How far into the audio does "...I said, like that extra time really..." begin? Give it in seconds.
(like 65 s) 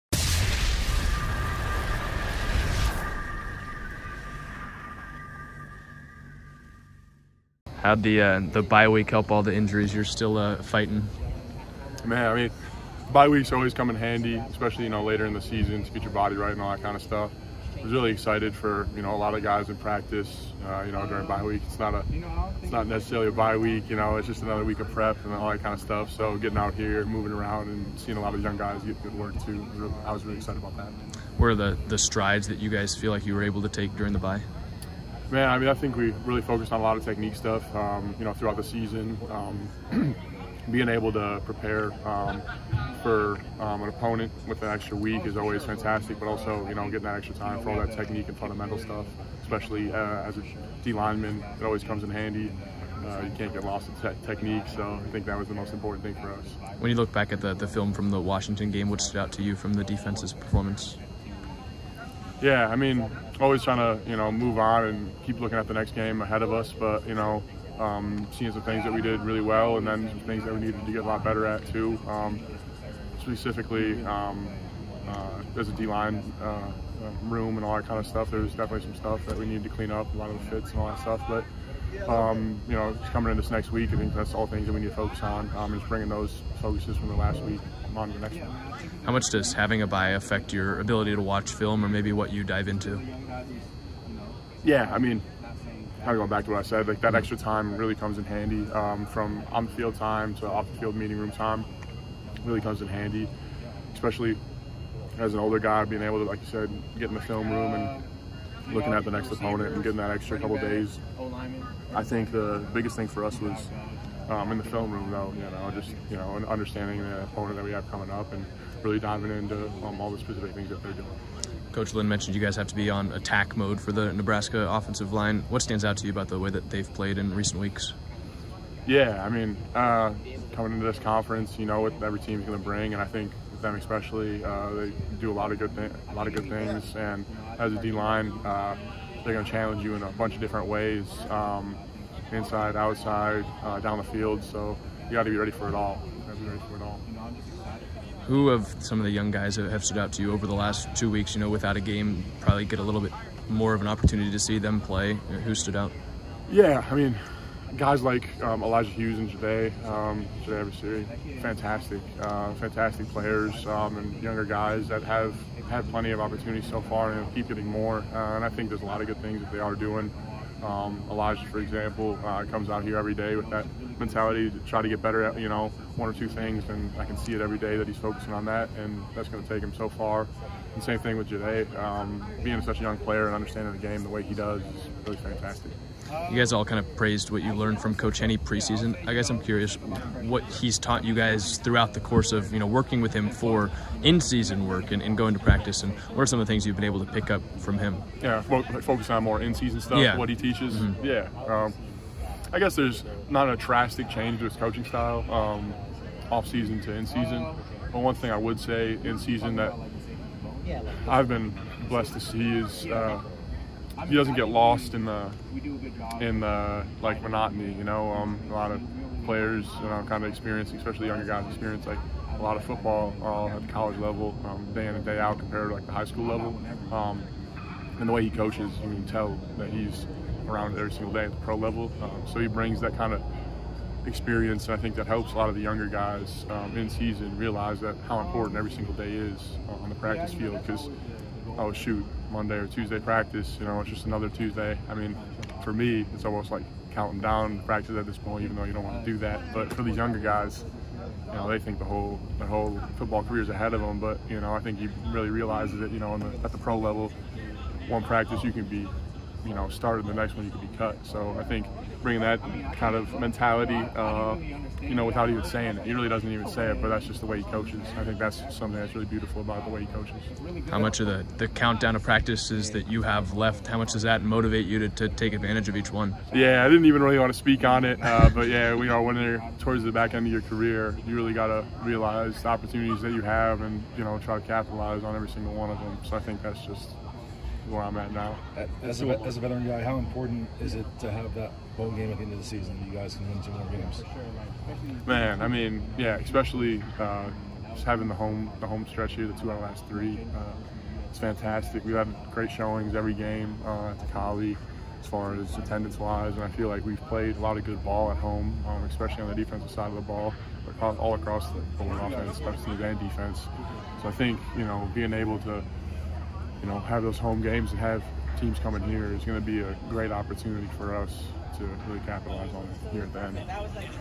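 96 s.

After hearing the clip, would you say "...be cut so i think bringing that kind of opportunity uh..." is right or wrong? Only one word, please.
wrong.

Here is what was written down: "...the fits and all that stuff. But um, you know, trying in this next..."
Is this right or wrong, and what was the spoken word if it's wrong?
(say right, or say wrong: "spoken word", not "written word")
wrong: "coming", not "trying".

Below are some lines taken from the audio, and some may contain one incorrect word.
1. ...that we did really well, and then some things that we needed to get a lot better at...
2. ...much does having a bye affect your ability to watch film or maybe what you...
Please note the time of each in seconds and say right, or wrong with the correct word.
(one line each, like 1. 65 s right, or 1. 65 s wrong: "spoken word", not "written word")
1. 68 s right
2. 89 s right.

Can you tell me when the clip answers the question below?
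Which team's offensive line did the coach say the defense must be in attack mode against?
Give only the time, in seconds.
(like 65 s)
124 s.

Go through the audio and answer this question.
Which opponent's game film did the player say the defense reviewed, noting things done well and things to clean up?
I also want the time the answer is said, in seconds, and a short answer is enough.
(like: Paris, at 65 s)
Washington, at 58 s.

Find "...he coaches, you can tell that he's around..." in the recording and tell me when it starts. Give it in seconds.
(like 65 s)
228 s.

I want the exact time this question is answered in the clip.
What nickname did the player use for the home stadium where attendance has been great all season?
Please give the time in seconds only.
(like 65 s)
304 s.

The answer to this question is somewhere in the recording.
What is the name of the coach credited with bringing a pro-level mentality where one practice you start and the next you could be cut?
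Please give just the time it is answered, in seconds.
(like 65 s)
187 s.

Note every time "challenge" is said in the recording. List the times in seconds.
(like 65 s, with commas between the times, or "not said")
139 s.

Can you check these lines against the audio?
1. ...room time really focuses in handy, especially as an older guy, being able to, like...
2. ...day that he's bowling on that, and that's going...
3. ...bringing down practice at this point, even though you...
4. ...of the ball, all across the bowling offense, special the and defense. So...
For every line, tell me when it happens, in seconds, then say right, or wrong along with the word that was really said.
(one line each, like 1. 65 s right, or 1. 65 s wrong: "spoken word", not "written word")
1. 101 s wrong: "comes", not "focuses"
2. 177 s wrong: "focusing", not "bowling"
3. 246 s wrong: "counting", not "bringing"
4. 309 s right.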